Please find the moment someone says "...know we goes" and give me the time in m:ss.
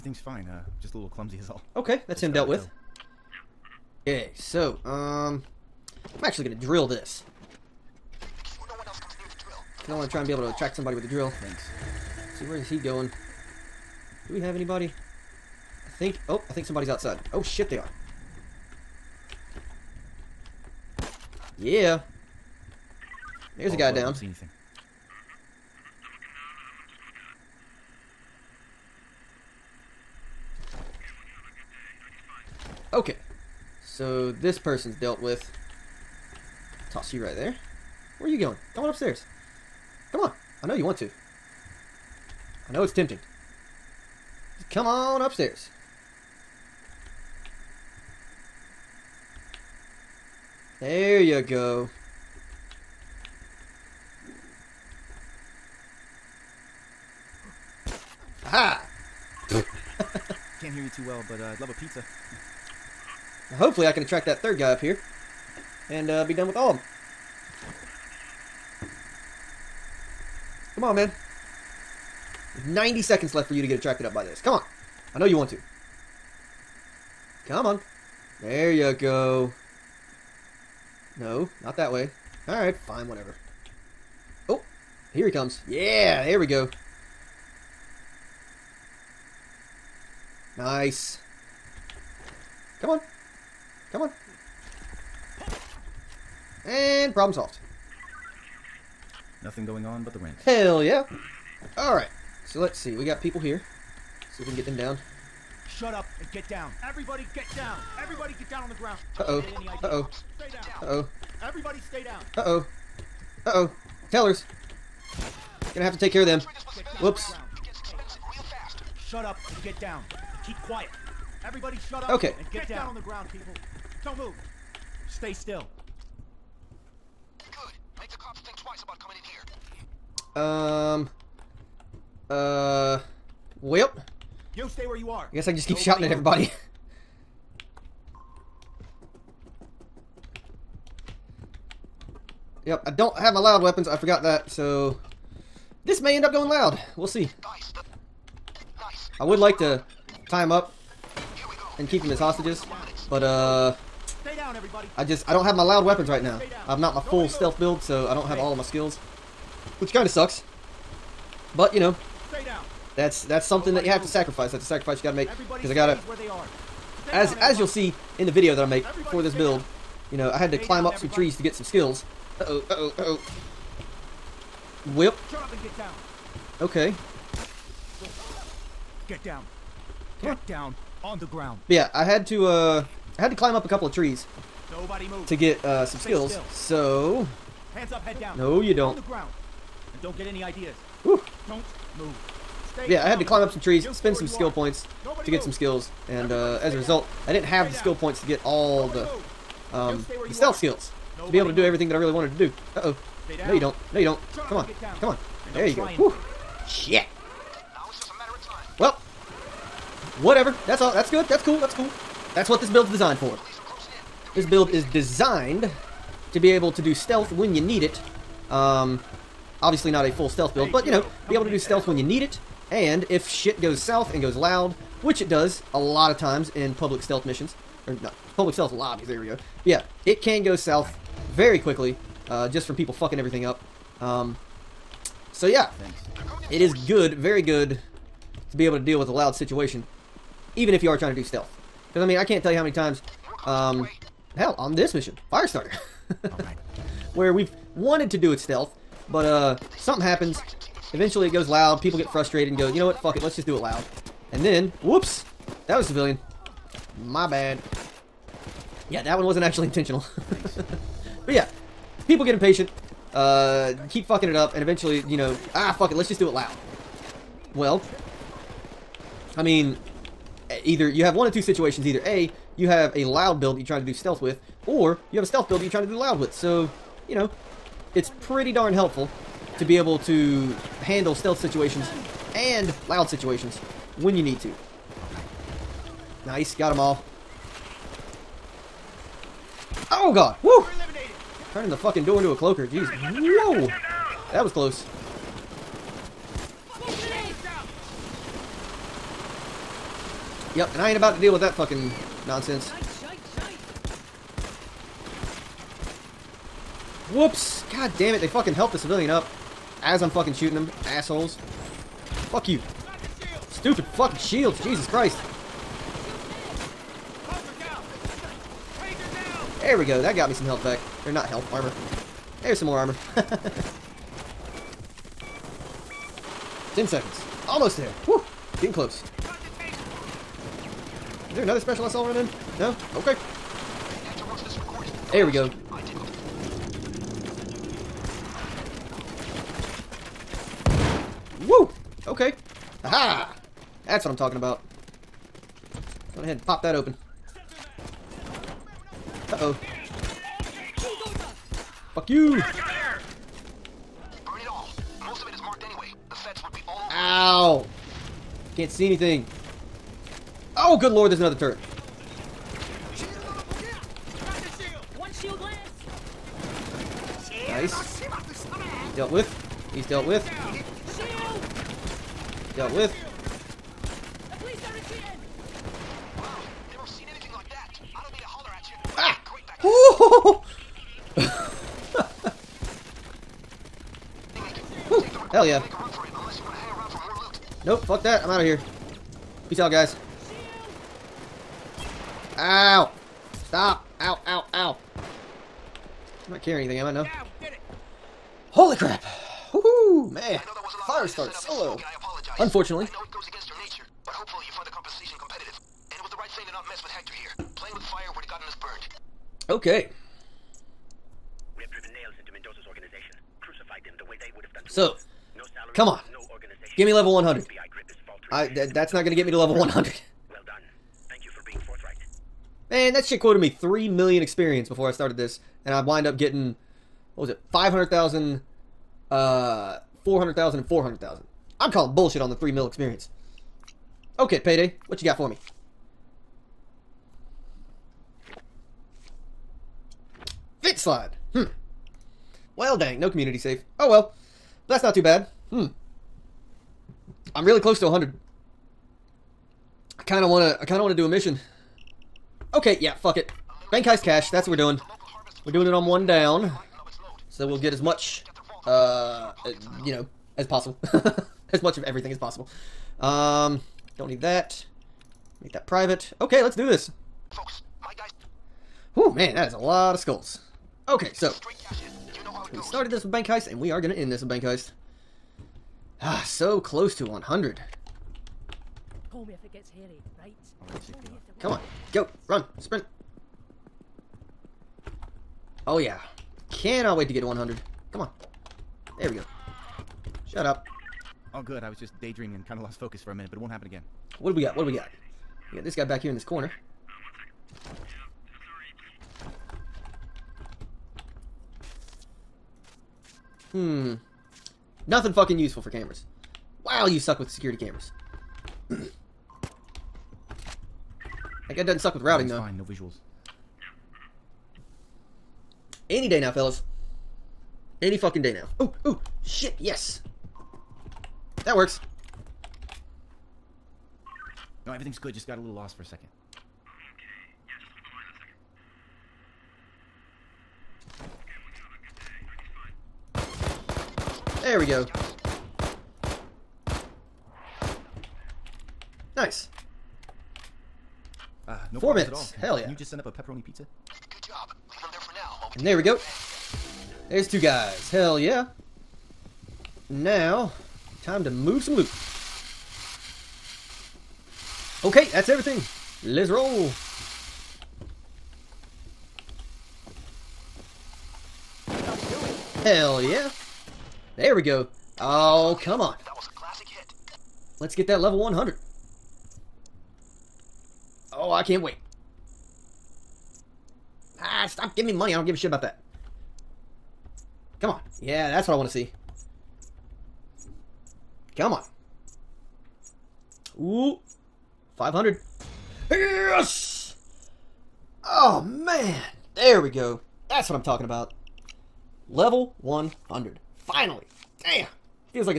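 7:52.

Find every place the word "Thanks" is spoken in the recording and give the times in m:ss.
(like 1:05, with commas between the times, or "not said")
0:11, 7:01.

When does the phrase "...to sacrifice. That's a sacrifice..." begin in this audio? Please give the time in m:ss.
2:44.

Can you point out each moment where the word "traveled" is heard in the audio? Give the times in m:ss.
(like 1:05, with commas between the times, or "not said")
not said.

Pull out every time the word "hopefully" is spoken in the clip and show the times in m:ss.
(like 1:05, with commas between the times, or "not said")
1:03, 6:44.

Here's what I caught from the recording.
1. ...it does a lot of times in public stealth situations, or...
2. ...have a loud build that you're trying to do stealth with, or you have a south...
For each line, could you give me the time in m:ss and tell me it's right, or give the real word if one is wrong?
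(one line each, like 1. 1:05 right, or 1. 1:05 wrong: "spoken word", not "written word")
1. 3:45 wrong: "missions", not "situations"
2. 4:32 wrong: "stealth", not "south".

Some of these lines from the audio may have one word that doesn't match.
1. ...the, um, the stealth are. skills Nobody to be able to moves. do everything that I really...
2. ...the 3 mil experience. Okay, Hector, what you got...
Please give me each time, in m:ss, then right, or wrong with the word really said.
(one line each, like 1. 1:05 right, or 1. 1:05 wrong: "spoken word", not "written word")
1. 3:19 right
2. 7:12 wrong: "Payday", not "Hector".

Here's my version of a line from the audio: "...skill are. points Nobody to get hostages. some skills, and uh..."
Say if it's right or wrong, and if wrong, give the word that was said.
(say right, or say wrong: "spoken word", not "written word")
wrong: "moves", not "hostages".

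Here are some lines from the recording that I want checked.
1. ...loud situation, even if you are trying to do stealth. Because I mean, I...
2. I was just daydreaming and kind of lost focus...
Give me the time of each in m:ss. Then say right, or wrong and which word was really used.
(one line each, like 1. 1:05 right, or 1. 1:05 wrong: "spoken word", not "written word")
1. 3:59 right
2. 8:11 right.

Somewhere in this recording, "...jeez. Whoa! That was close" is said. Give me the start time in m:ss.
4:52.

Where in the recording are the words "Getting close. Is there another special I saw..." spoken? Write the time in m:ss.
5:28.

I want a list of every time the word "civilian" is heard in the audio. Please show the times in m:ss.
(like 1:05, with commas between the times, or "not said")
4:15, 5:08.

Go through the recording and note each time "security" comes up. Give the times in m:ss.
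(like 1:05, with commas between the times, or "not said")
8:27.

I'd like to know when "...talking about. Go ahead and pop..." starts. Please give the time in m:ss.
5:44.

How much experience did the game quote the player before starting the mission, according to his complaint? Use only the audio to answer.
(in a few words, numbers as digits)
3 million.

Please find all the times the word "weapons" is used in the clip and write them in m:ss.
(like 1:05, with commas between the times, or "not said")
2:23, 2:35.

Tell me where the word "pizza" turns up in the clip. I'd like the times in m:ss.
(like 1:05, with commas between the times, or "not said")
1:01, 9:03.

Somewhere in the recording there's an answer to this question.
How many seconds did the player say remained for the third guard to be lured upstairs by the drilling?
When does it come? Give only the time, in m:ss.
1:12.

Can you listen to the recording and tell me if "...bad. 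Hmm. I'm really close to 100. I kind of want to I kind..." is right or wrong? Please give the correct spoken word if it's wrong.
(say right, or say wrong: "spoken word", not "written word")
right.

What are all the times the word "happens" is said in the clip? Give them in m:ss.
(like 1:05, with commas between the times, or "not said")
4:10, 8:13.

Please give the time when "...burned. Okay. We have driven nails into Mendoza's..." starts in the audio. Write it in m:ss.
6:48.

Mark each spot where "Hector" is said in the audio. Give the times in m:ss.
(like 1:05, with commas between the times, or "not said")
6:46.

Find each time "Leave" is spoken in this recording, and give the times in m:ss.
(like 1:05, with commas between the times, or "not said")
9:04.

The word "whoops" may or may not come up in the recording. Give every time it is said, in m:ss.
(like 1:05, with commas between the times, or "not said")
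1:56, 4:14, 5:07.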